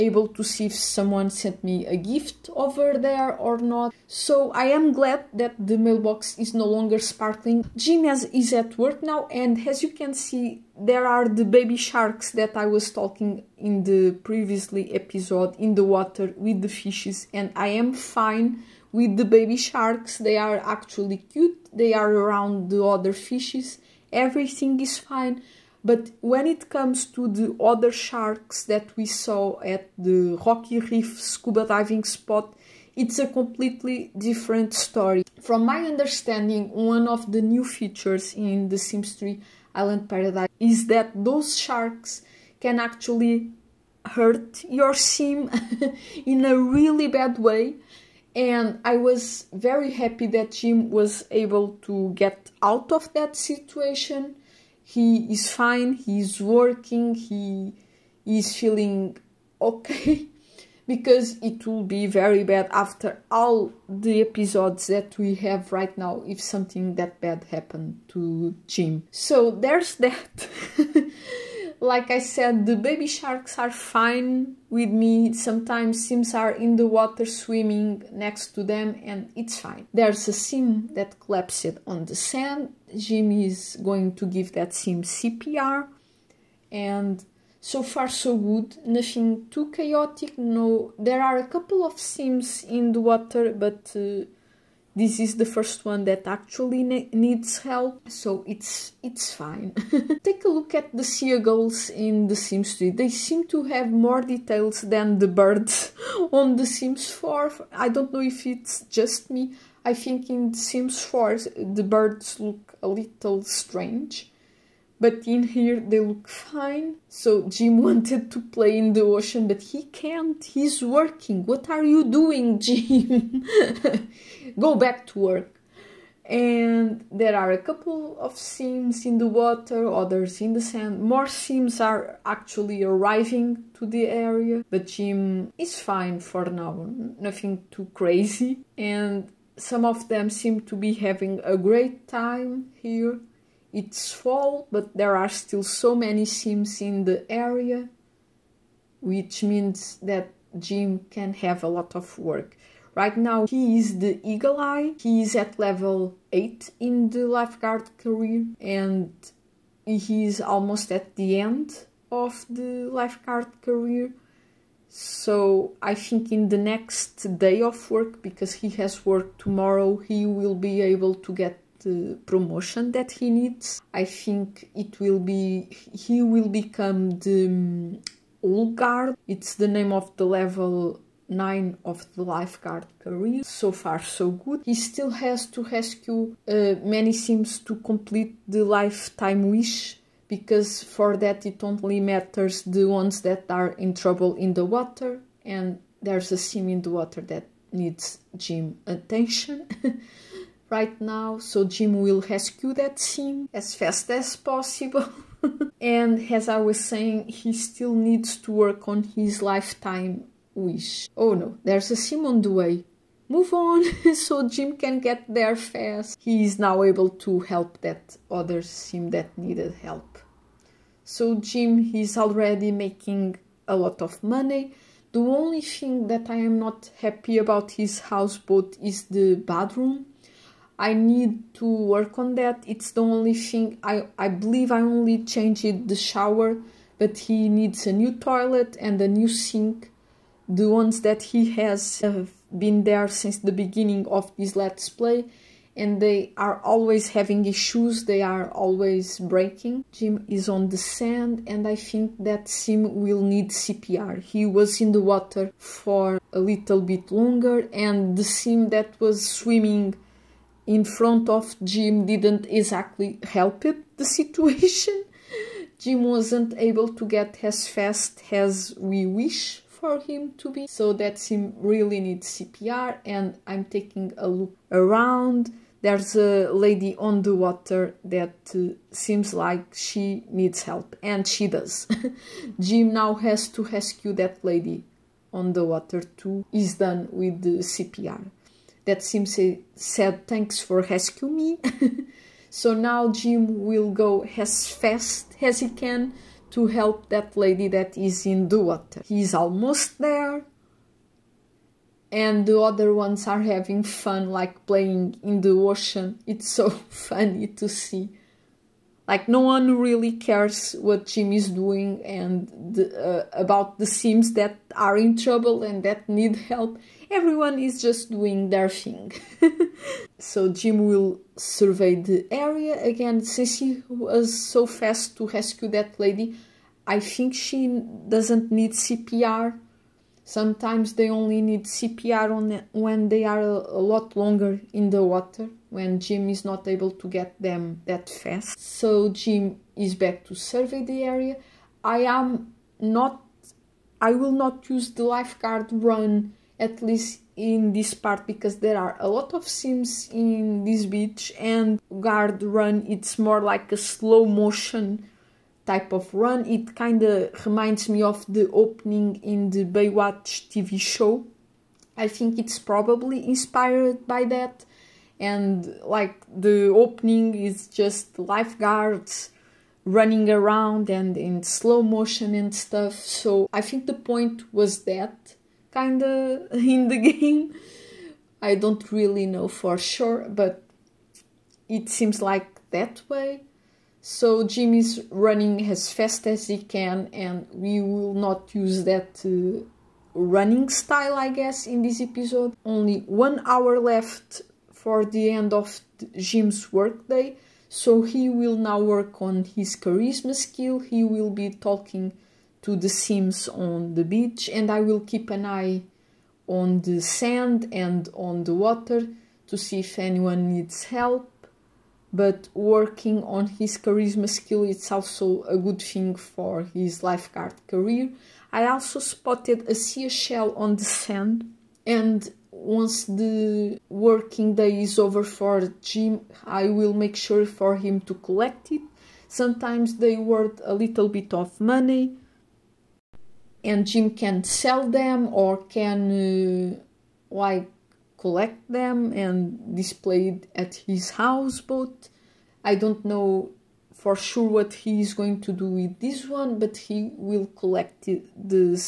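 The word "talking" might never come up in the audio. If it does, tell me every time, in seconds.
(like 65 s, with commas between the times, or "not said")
12 s, 401 s.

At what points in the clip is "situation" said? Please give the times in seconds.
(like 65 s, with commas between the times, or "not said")
53 s, 264 s.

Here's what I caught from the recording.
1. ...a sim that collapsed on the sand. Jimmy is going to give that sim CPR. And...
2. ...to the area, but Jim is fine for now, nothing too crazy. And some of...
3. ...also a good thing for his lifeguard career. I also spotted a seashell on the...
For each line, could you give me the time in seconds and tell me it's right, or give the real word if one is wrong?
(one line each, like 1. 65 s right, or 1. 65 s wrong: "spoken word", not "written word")
1. 80 s right
2. 133 s right
3. 414 s right.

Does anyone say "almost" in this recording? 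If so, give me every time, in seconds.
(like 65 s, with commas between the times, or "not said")
160 s, 299 s.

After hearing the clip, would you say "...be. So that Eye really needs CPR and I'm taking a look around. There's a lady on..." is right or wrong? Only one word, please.
wrong.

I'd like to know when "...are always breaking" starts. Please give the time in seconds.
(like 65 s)
248 s.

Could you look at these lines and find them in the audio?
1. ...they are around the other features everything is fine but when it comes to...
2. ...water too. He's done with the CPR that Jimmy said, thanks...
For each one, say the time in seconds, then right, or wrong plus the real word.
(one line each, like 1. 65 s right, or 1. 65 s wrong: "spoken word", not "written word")
1. 21 s wrong: "fishes", not "features"
2. 285 s wrong: "Sim", not "Jimmy".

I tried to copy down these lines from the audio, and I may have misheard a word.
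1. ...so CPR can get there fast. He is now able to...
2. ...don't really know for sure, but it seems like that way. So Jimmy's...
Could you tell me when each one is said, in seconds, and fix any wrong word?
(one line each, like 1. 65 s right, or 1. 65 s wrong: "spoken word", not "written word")
1. 214 s wrong: "Jim", not "CPR"
2. 378 s right.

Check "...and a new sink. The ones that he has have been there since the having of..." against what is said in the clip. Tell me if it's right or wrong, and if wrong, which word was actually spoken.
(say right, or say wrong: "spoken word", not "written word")
wrong: "beginning", not "having".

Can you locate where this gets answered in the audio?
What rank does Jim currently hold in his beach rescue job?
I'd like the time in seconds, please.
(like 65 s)
154 s.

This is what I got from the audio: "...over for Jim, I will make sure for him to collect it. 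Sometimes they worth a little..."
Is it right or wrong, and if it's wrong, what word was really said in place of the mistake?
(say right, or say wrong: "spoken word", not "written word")
right.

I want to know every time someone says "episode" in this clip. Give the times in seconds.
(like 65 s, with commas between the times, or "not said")
14 s, 64 s, 392 s.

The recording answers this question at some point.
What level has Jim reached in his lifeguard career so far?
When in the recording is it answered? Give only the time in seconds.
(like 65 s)
155 s.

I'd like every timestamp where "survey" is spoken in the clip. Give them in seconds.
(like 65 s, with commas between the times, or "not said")
321 s, 340 s.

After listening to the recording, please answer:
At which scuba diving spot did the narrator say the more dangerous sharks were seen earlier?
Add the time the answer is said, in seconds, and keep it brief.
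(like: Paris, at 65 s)
Rocky reef, at 30 s.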